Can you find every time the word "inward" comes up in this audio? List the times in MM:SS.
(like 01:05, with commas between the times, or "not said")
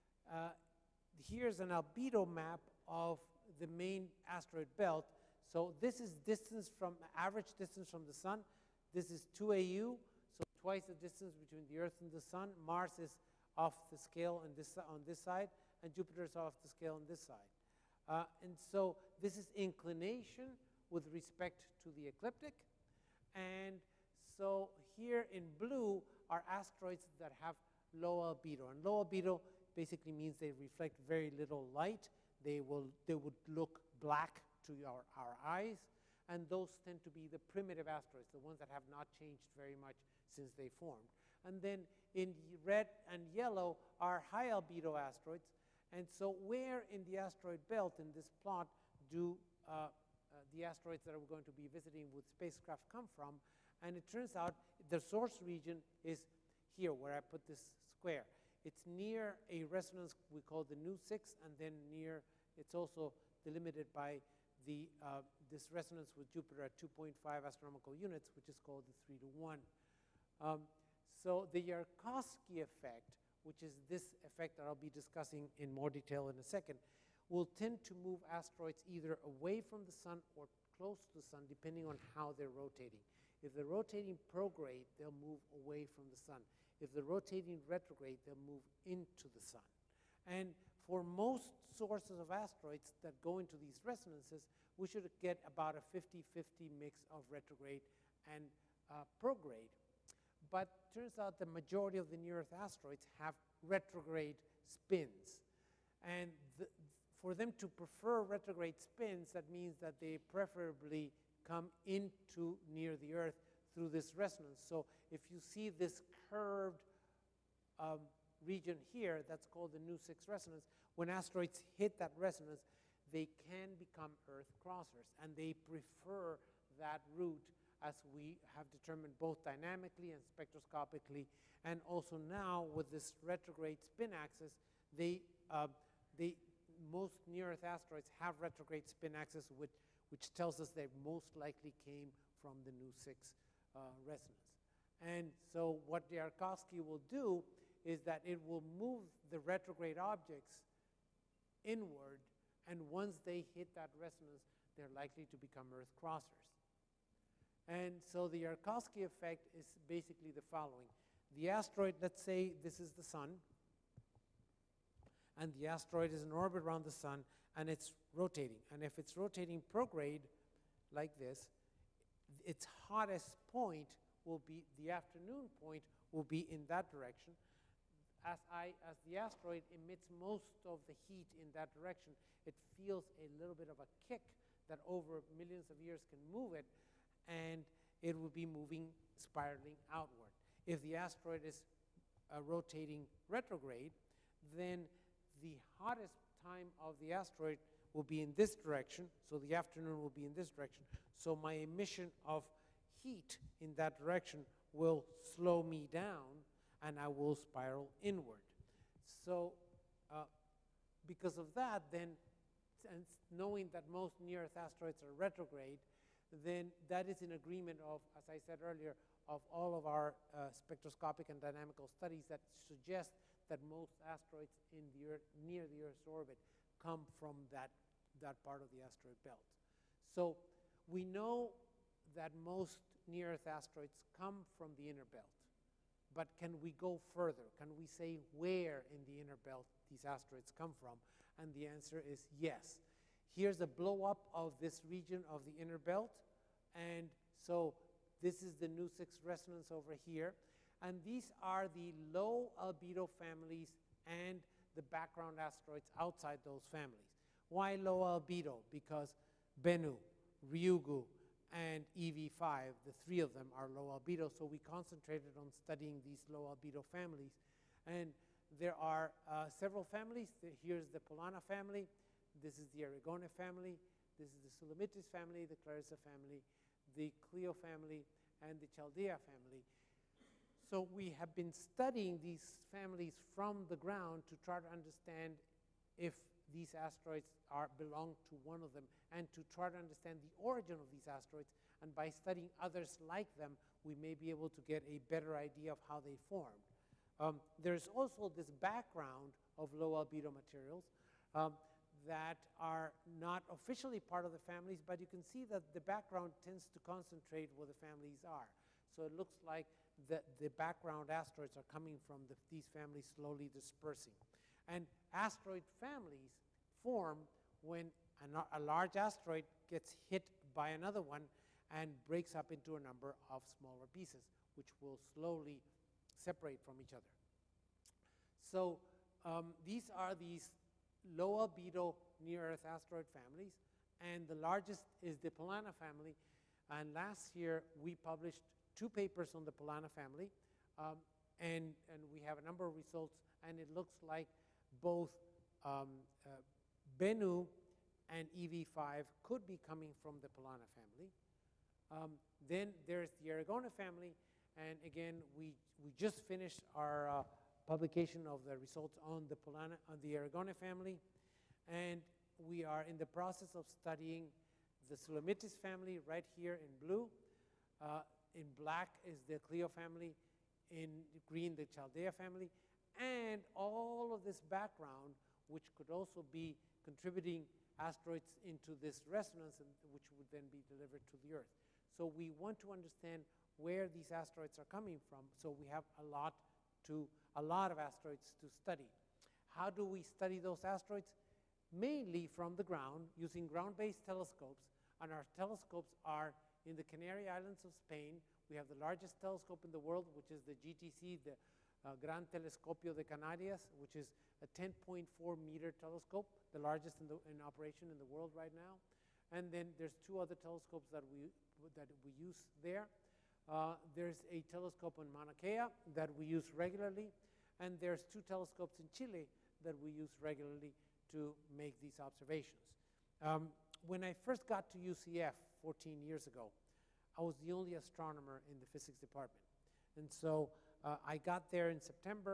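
02:31, 03:28.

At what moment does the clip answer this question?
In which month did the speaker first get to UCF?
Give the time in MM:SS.
07:11.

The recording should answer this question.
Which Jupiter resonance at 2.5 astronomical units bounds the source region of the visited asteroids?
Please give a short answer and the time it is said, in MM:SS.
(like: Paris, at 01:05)
3 to 1, at 01:08.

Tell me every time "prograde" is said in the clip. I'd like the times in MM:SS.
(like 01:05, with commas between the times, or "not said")
01:24, 01:39, 02:49.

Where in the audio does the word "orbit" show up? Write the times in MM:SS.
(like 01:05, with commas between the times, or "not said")
02:46, 03:46.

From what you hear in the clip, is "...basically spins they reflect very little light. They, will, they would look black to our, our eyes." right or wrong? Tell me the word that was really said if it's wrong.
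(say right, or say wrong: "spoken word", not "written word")
wrong: "means", not "spins".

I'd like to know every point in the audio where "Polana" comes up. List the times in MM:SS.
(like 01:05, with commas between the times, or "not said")
04:30, 05:35, 05:39, 05:50, 05:59.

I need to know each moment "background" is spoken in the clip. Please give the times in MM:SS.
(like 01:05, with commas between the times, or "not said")
04:14, 04:58, 05:05, 05:10, 06:14.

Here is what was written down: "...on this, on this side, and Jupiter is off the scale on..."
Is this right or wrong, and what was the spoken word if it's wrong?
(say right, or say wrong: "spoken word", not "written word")
right.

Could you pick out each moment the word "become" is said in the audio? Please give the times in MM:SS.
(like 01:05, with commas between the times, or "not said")
02:03, 02:35.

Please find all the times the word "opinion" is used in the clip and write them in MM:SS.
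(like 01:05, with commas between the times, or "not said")
not said.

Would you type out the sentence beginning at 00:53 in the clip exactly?
And it turns out the source region is here, where I put this square.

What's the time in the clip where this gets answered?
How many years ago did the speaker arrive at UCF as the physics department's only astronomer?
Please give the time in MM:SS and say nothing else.
07:05.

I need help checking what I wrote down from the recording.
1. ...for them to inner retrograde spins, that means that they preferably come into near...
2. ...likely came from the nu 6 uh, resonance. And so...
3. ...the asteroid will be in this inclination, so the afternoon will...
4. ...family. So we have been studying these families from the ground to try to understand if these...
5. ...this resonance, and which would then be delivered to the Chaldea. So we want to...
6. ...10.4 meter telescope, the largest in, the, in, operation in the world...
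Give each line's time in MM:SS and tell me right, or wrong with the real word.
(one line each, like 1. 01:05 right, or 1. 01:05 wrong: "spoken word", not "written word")
1. 01:47 wrong: "prefer", not "inner"
2. 02:21 right
3. 03:17 wrong: "direction", not "inclination"
4. 04:39 right
5. 06:18 wrong: "Earth", not "Chaldea"
6. 06:44 right.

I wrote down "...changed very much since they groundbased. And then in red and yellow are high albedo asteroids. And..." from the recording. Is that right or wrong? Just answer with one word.
wrong.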